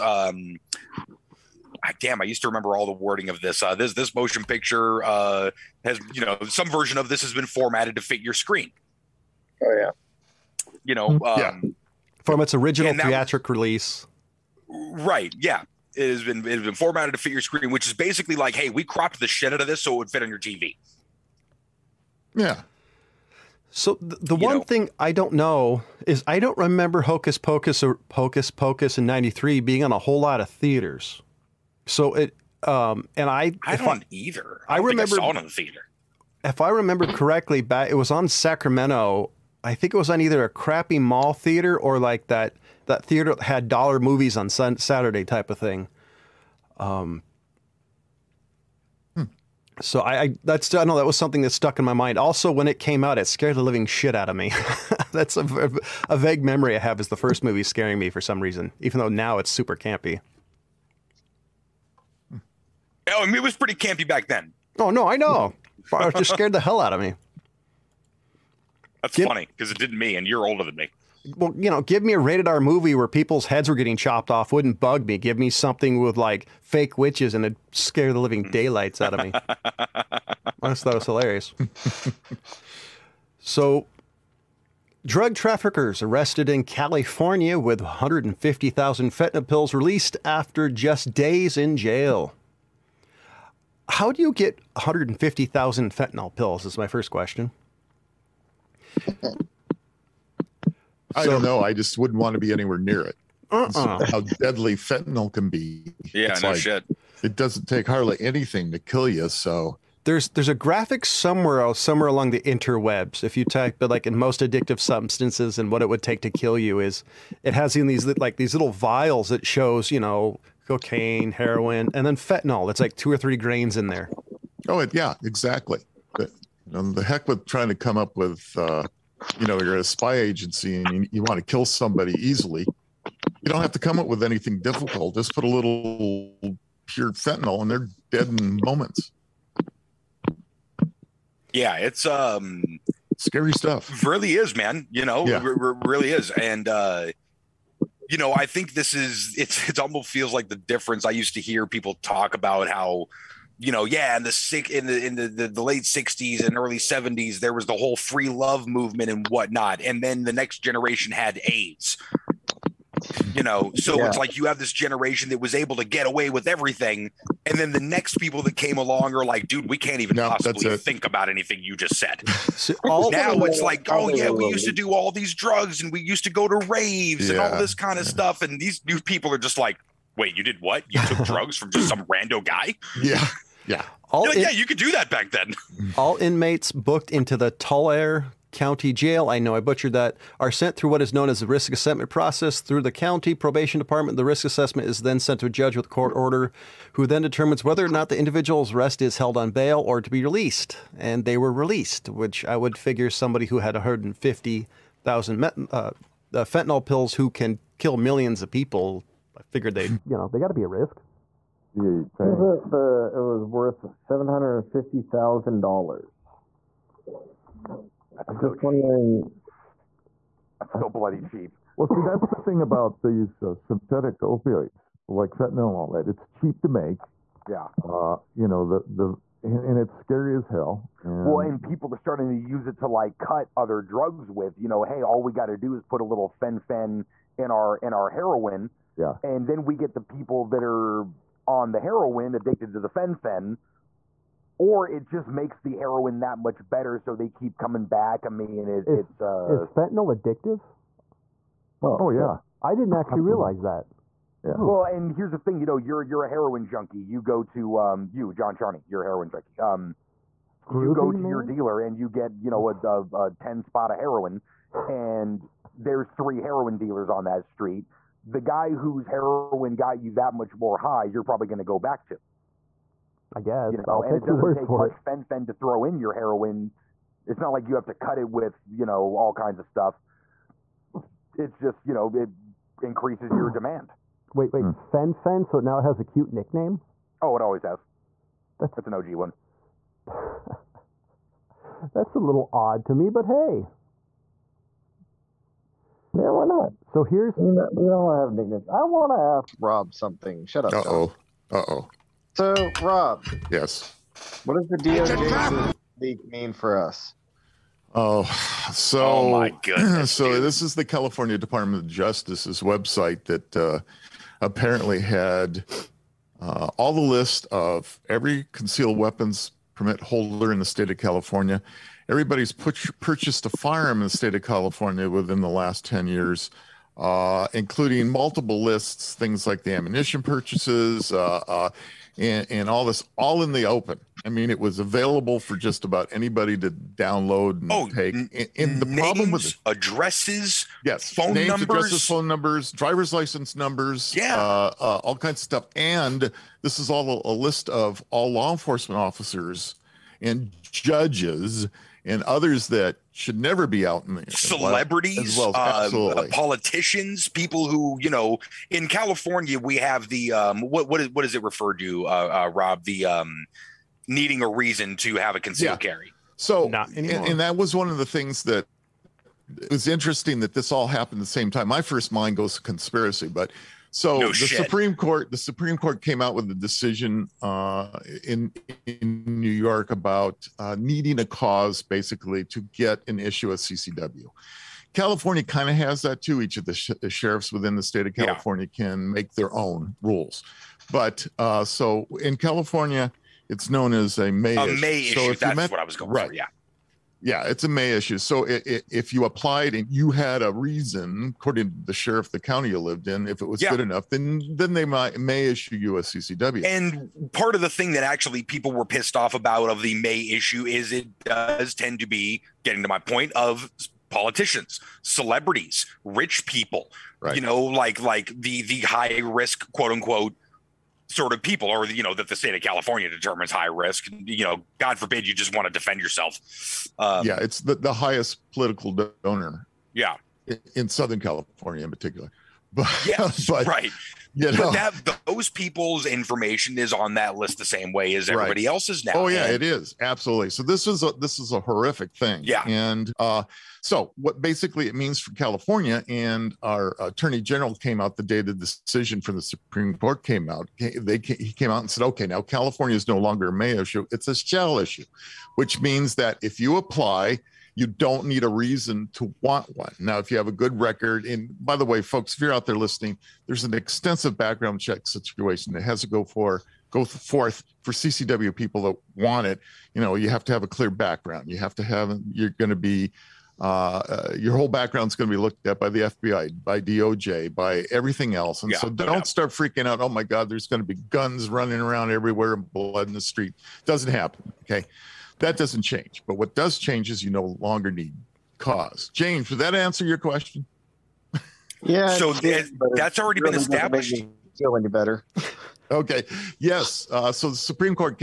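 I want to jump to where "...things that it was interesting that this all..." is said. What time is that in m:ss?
6:08.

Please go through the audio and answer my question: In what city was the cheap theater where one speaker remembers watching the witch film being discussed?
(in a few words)
Sacramento.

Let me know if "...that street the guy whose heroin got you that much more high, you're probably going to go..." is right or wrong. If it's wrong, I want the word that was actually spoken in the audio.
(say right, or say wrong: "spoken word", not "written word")
right.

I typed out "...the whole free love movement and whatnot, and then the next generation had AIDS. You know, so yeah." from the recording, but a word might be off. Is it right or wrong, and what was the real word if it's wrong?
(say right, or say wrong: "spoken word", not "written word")
right.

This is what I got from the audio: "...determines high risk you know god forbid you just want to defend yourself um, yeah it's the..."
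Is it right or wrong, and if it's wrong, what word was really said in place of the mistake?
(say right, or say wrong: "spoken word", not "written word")
right.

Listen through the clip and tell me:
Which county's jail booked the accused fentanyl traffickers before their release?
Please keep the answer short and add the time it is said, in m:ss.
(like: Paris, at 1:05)
Tulare County, at 3:07.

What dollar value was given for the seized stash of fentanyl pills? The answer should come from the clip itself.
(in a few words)
$750,000.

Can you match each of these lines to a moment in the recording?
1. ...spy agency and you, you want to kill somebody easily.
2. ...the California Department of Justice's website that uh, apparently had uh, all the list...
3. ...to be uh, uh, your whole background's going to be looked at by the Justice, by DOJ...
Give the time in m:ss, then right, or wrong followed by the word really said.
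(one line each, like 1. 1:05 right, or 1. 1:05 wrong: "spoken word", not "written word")
1. 2:09 right
2. 5:10 right
3. 7:52 wrong: "FBI", not "Justice".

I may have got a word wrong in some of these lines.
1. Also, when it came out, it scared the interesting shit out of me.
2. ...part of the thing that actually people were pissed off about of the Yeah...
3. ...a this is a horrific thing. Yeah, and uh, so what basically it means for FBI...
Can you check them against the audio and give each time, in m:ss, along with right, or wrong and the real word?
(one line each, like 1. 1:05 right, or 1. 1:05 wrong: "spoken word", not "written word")
1. 0:52 wrong: "living", not "interesting"
2. 6:47 wrong: "May", not "Yeah"
3. 7:21 wrong: "California", not "FBI".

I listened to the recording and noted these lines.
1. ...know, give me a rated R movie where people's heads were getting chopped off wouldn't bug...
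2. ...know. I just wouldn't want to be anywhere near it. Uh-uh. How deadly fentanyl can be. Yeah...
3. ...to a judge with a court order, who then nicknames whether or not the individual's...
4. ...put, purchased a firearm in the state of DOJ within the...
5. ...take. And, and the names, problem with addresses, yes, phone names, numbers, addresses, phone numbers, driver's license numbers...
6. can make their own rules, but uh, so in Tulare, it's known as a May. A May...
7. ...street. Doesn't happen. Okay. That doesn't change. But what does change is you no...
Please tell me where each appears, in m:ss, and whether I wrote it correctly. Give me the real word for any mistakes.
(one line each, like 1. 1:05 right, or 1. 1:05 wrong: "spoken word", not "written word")
1. 1:11 right
2. 1:41 right
3. 3:15 wrong: "determines", not "nicknames"
4. 5:22 wrong: "California", not "DOJ"
5. 5:37 right
6. 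6:28 wrong: "California", not "Tulare"
7. 8:03 right.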